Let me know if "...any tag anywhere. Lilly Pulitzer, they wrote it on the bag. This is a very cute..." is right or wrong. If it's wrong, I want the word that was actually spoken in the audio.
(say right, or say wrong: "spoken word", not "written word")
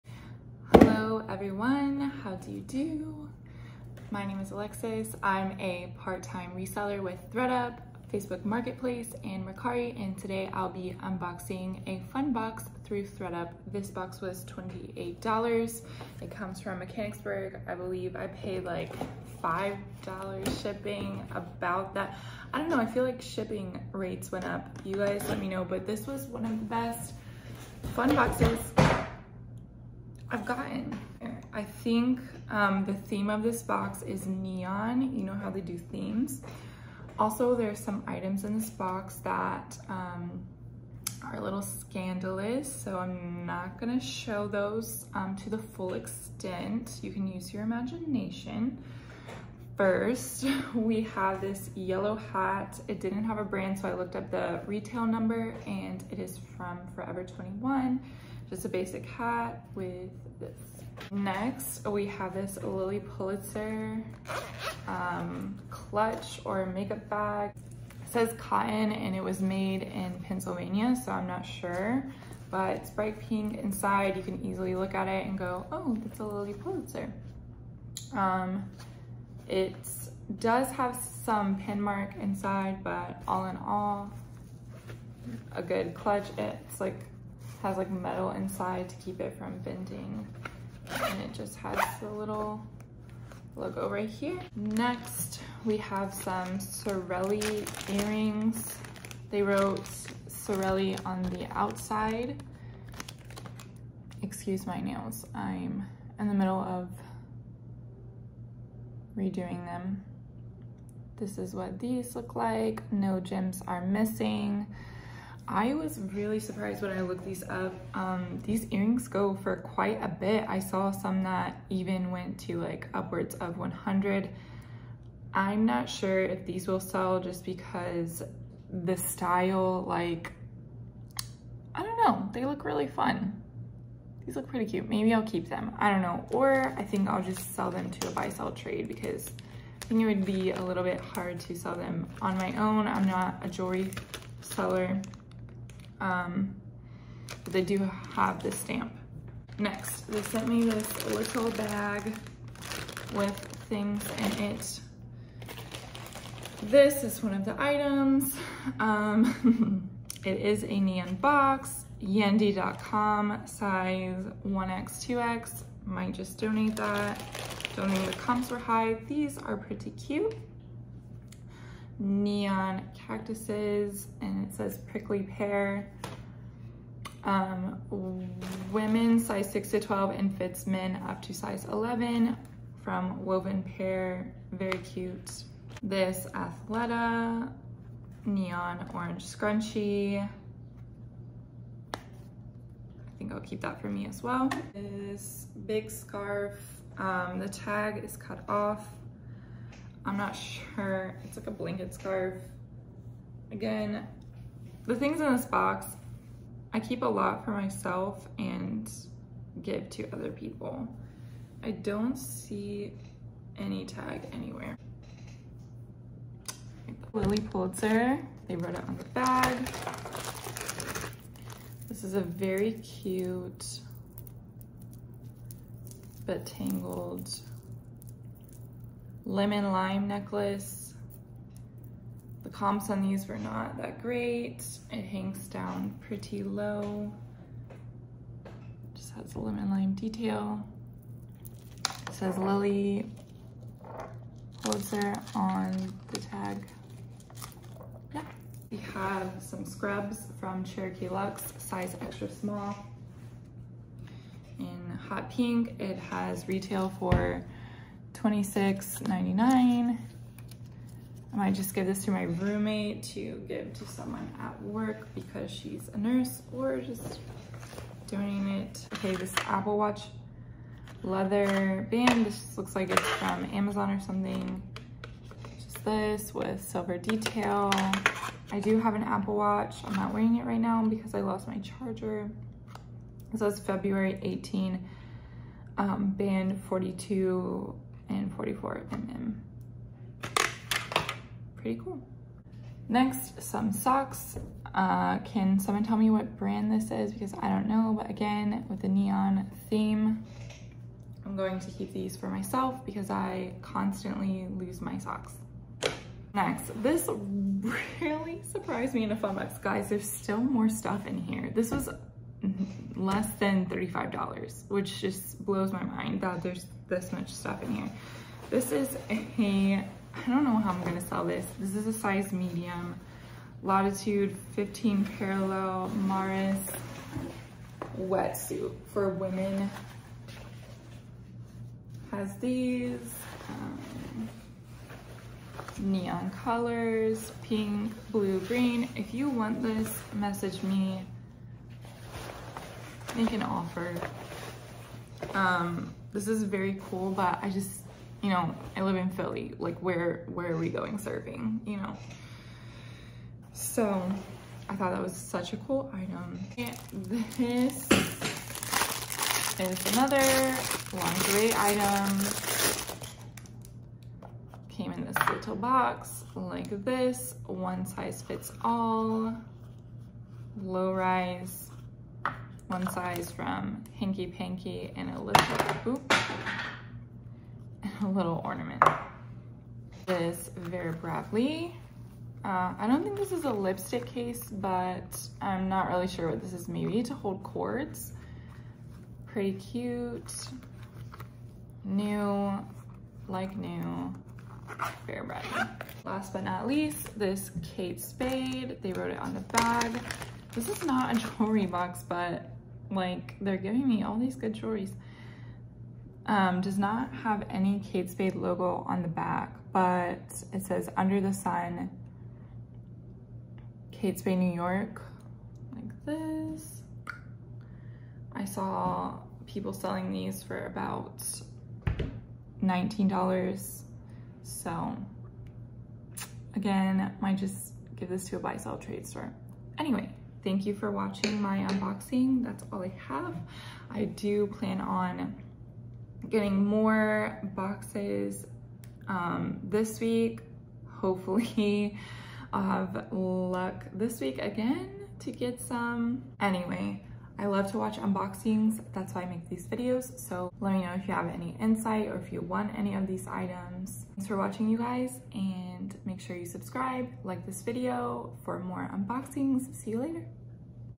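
right.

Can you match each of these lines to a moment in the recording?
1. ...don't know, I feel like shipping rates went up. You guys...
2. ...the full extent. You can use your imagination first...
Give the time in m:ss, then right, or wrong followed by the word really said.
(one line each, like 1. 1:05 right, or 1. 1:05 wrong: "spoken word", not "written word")
1. 0:22 right
2. 0:45 right.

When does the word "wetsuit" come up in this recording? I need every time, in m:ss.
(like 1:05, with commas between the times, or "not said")
5:27.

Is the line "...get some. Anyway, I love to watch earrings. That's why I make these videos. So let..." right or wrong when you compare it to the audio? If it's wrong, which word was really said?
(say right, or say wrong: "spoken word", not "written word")
wrong: "unboxings", not "earrings".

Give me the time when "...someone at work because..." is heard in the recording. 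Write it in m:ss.
4:23.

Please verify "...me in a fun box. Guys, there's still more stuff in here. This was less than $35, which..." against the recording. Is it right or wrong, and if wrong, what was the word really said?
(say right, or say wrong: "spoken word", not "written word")
right.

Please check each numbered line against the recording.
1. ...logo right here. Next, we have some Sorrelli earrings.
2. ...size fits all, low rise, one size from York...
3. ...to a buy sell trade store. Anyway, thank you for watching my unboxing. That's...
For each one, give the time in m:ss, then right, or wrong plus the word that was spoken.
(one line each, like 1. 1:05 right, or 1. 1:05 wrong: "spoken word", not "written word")
1. 1:33 right
2. 6:07 wrong: "Hanky", not "York"
3. 7:08 right.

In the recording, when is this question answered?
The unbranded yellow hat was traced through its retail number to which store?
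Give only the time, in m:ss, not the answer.
0:56.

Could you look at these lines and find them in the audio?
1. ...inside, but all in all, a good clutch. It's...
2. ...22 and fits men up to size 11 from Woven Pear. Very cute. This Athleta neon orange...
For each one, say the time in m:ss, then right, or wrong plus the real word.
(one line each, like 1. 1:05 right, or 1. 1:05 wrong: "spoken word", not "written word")
1. 1:22 right
2. 2:59 wrong: "12", not "22".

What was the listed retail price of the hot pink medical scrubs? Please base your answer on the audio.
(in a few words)
$26.99.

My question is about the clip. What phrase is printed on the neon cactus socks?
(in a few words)
prickly pear.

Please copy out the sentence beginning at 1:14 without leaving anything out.
You can easily look at it and go, oh, that's a Lilly Pulitzer.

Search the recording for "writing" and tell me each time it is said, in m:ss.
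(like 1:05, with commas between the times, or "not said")
not said.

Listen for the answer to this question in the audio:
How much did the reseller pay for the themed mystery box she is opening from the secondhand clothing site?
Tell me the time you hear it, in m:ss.
0:14.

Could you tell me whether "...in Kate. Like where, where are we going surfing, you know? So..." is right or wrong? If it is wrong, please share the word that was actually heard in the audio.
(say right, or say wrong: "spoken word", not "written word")
wrong: "Philly", not "Kate".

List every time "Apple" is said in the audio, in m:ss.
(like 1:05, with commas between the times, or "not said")
4:29, 4:39.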